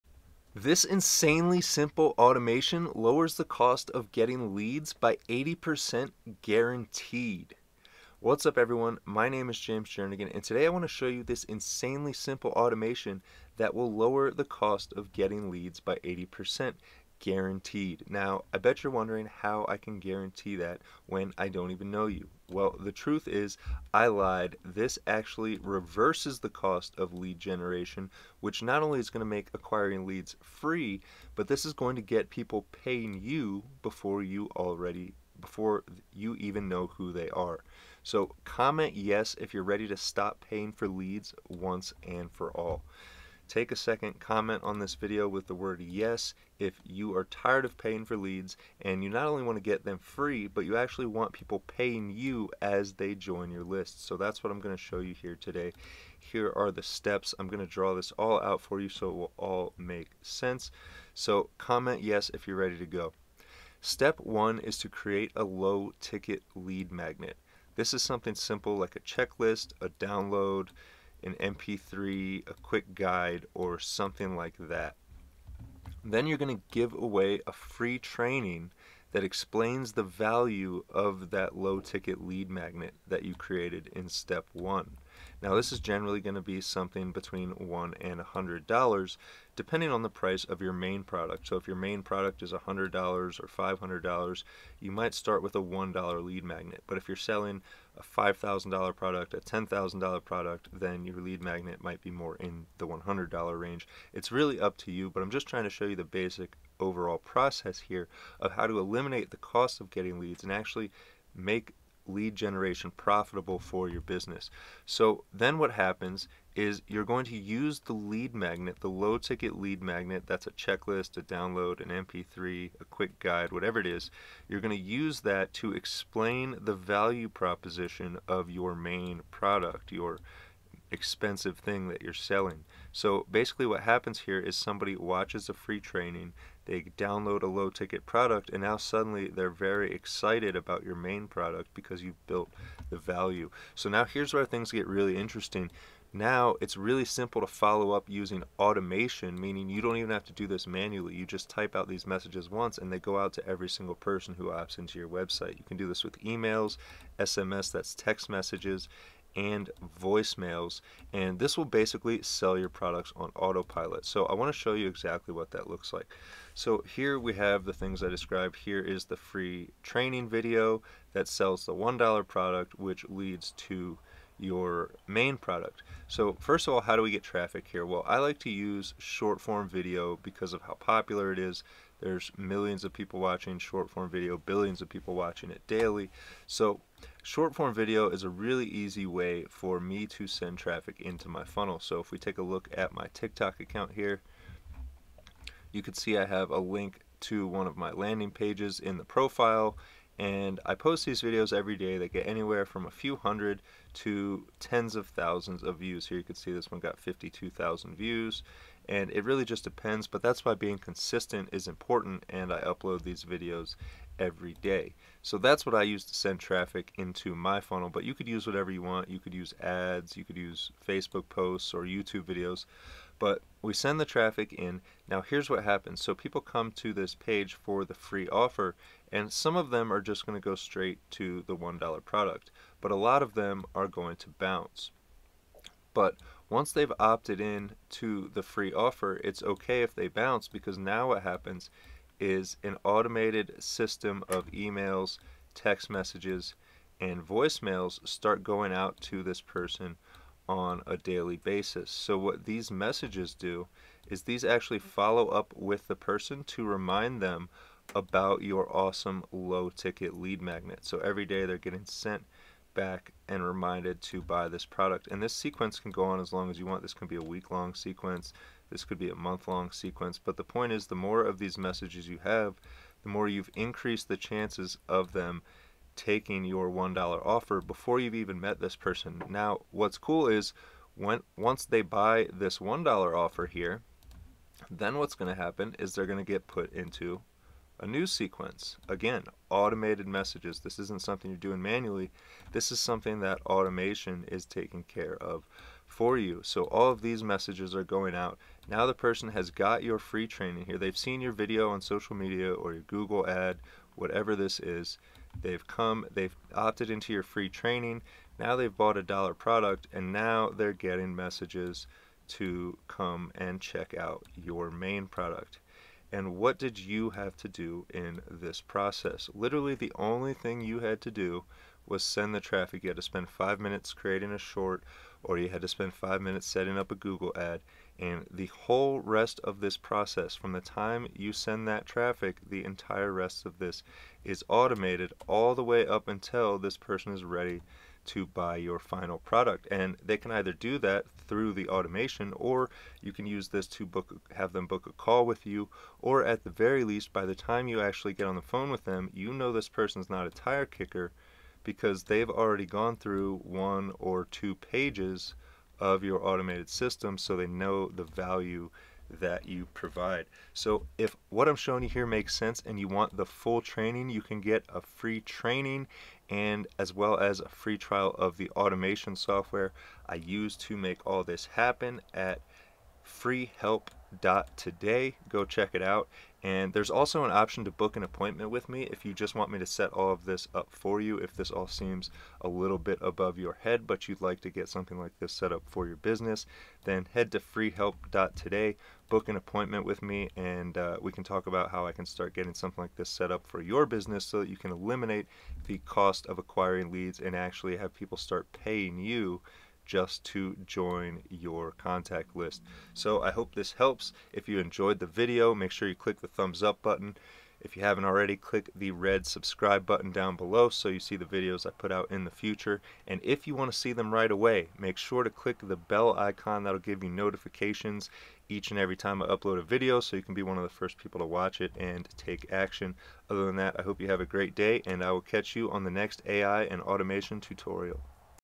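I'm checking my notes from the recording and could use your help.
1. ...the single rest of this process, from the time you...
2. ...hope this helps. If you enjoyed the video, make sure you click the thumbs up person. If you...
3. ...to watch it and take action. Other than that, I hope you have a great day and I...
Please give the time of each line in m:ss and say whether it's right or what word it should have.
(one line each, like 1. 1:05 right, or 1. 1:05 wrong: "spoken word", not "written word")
1. 5:28 wrong: "whole", not "single"
2. 6:43 wrong: "button", not "person"
3. 7:01 right.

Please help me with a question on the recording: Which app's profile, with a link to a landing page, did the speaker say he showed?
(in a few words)
TikTok.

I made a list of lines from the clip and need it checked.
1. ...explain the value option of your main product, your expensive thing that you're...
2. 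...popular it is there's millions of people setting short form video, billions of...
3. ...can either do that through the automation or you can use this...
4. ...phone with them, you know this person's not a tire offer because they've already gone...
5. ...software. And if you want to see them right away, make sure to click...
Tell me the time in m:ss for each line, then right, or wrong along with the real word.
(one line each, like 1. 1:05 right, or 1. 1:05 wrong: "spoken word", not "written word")
1. 2:05 wrong: "proposition", not "option"
2. 3:00 wrong: "watching", not "setting"
3. 5:40 right
4. 5:48 wrong: "kicker", not "offer"
5. 6:52 wrong: "future", not "software".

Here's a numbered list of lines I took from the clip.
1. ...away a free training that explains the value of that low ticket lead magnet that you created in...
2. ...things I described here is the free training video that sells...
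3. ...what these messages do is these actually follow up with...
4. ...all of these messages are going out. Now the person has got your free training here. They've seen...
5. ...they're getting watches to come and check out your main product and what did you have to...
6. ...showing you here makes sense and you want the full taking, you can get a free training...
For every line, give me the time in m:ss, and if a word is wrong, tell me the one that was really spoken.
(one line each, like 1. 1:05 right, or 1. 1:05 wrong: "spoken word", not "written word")
1. 1:16 right
2. 2:47 right
3. 4:12 right
4. 4:56 right
5. 5:10 wrong: "messages", not "watches"
6. 6:01 wrong: "training", not "taking".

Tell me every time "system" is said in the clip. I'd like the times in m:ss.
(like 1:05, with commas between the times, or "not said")
4:03, 5:56.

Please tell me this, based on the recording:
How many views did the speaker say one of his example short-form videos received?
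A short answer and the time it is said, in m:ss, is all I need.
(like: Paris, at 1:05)
52,000, at 3:26.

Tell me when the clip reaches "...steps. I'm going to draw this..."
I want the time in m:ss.
0:56.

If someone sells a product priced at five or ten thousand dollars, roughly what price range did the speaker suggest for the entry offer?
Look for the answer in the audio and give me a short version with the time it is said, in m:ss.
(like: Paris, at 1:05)
$100, at 1:42.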